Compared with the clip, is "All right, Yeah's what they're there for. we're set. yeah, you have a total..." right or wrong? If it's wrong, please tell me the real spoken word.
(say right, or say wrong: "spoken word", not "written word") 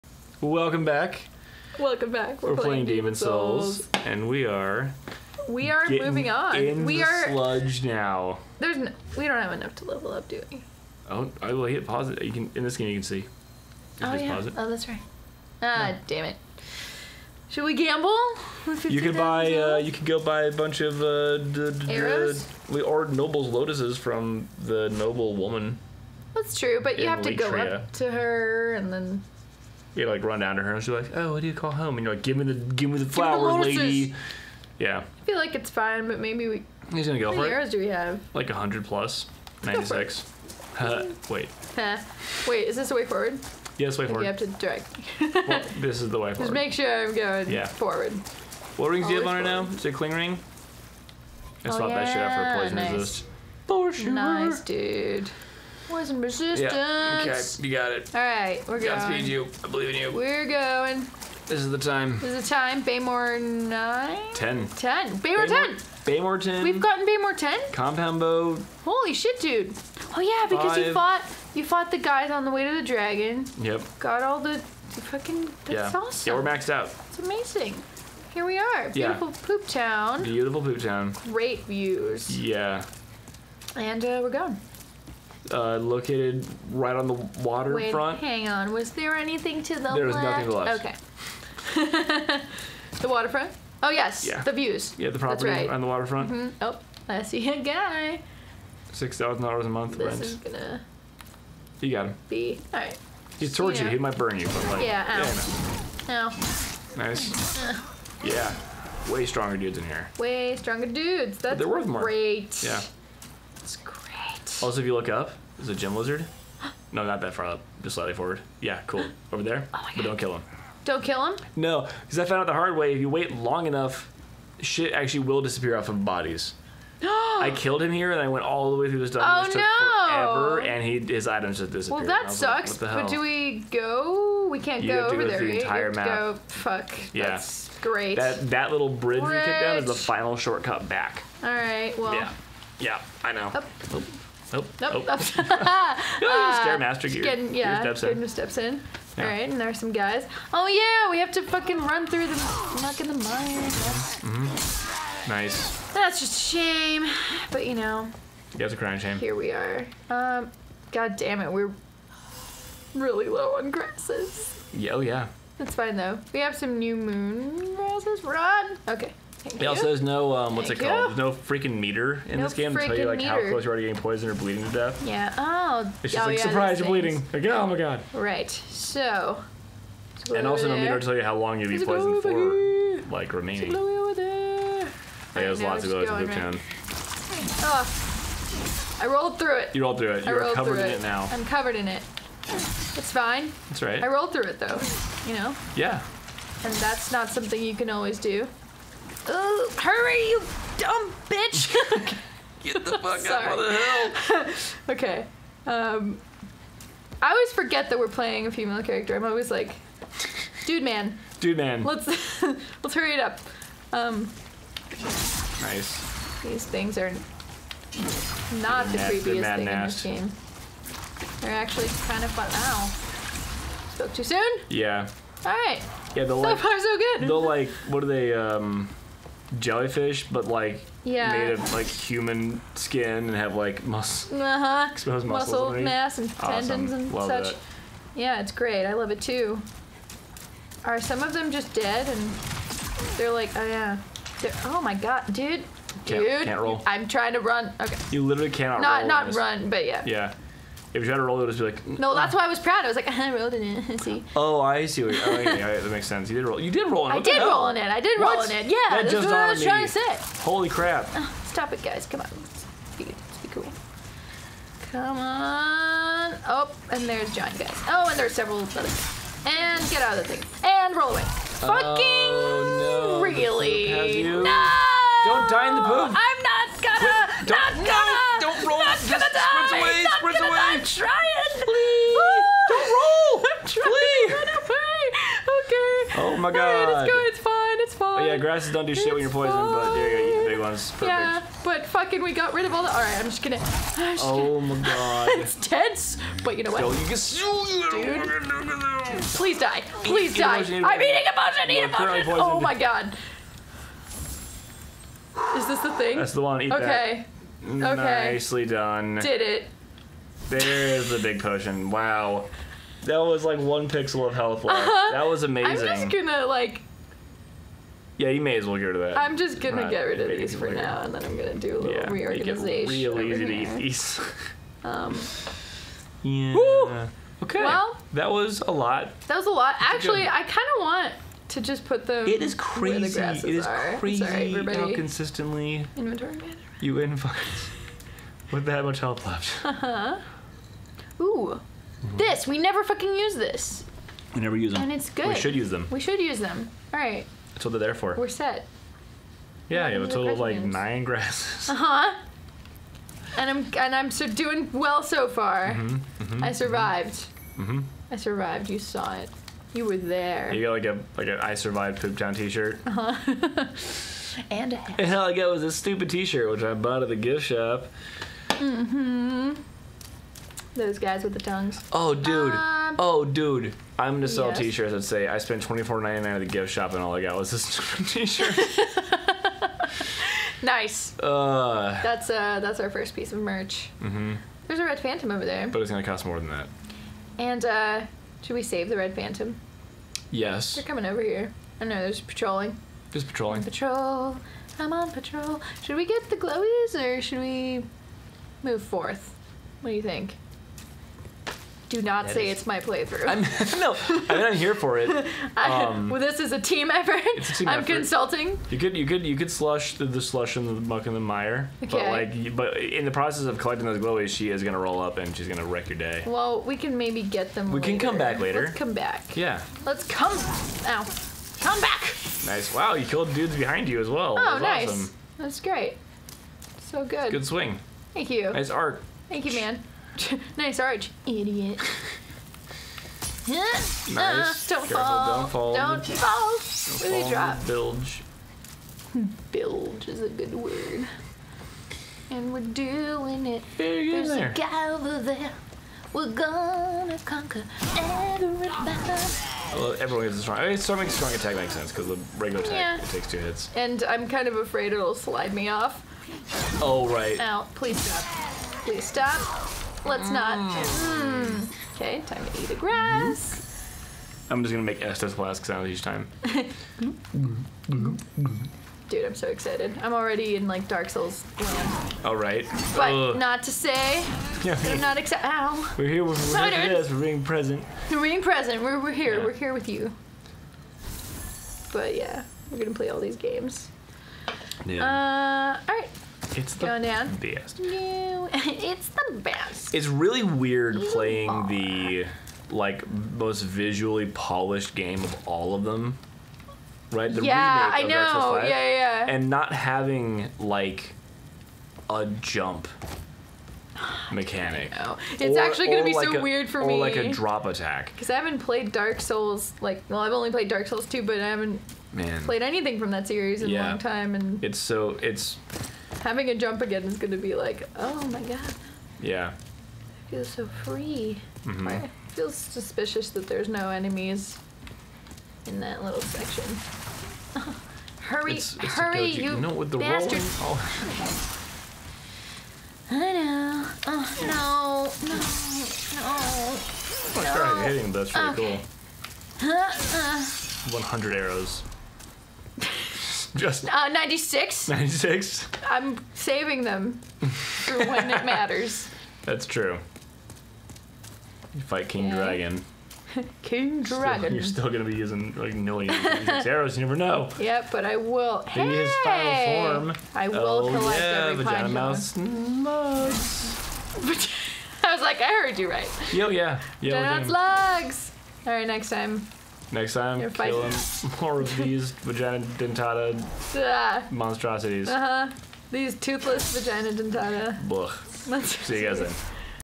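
wrong: "That", not "Yeah".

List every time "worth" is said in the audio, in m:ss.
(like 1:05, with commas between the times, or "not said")
1:51.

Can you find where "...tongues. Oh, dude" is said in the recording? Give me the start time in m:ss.
6:11.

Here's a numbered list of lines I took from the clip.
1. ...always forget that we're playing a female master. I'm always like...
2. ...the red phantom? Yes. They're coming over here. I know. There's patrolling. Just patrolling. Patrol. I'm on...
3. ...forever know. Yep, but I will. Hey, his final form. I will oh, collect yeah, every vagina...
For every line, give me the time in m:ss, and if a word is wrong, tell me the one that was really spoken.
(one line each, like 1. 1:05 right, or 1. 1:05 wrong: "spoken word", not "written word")
1. 3:27 wrong: "character", not "master"
2. 6:28 right
3. 9:17 wrong: "never", not "forever".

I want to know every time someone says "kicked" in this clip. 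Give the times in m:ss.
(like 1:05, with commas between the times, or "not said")
2:19.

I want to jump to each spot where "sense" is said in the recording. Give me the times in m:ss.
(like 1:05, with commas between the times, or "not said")
4:16, 7:31.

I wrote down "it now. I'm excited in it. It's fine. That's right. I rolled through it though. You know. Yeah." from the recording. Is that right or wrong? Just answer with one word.
wrong.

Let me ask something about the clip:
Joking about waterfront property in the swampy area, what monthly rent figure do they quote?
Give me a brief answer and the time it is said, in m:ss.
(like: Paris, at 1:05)
$6,000, at 1:38.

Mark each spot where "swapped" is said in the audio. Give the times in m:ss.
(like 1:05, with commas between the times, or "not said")
0:51.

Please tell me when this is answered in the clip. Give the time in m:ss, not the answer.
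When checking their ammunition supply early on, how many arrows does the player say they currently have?
0:39.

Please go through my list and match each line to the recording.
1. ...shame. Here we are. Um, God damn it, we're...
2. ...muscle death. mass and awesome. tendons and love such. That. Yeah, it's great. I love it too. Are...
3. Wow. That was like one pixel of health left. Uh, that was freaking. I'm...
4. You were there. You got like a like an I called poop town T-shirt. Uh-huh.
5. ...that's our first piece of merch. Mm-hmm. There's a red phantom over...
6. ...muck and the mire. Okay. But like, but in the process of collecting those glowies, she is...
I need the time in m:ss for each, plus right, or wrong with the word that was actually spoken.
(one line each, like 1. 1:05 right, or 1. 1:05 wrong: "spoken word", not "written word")
1. 2:38 right
2. 3:55 wrong: "underneath", not "death"
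3. 5:11 wrong: "amazing", not "freaking"
4. 5:59 wrong: "survived", not "called"
5. 6:22 right
6. 6:50 right.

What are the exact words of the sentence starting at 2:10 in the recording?
forever, and he his items just Well, disappeared.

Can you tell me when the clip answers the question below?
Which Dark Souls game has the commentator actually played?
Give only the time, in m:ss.
8:30.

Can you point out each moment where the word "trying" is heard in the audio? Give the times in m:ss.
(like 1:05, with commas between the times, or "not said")
4:07, 4:19.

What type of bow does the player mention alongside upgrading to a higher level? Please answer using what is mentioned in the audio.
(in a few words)
Compound bow.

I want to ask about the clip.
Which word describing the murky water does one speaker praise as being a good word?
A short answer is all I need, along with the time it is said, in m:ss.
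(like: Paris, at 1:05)
Bilge, at 7:19.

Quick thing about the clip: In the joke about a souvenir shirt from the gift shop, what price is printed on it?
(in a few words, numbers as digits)
$24.99.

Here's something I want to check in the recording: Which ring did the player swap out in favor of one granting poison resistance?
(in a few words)
Cling ring.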